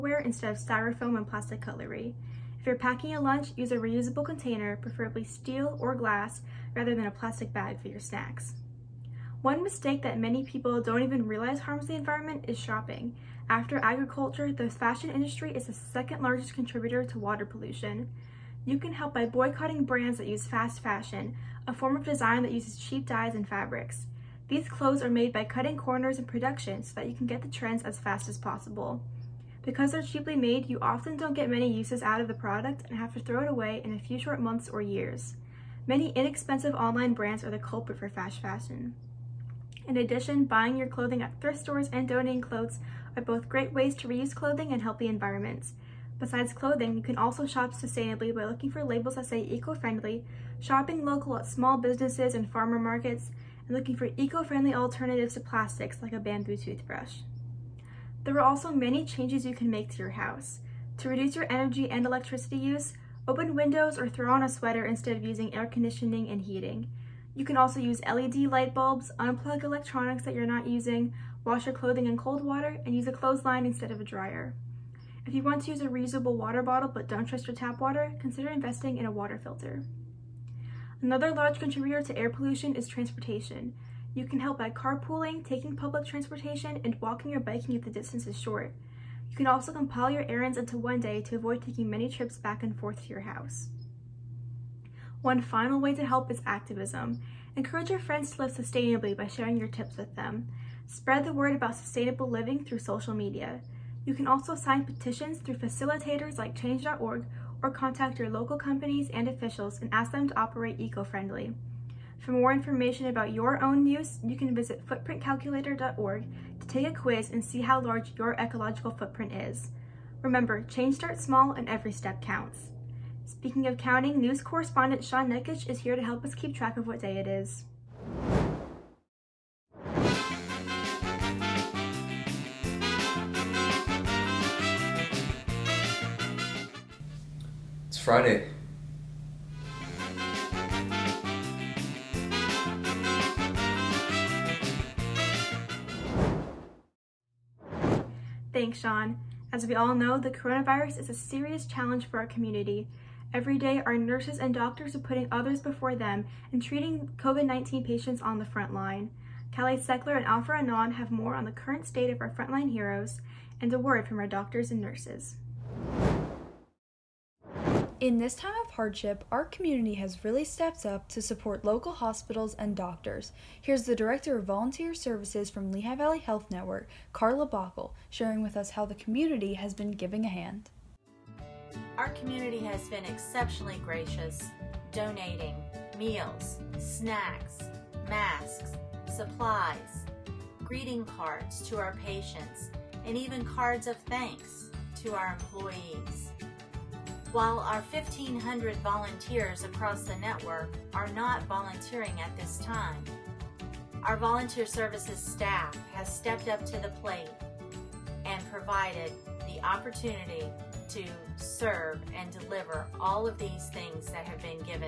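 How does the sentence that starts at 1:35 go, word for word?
One final way to help is activism.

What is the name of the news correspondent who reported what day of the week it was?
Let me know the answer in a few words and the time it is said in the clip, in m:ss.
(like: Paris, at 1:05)
Sean Nekic, at 2:05.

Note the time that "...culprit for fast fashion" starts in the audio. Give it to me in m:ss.
0:37.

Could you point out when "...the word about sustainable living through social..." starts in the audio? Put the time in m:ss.
1:41.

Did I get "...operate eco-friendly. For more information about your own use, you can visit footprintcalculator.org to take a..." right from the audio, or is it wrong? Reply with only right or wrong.
right.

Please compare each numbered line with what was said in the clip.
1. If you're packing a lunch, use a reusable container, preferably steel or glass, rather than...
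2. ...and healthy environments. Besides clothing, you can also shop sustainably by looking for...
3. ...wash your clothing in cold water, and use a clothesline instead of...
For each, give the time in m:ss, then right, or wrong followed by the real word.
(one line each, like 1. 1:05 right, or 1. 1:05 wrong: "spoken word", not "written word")
1. 0:02 right
2. 0:44 right
3. 1:11 right.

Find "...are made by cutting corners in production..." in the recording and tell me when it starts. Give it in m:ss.
0:25.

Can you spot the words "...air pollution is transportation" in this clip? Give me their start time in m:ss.
1:22.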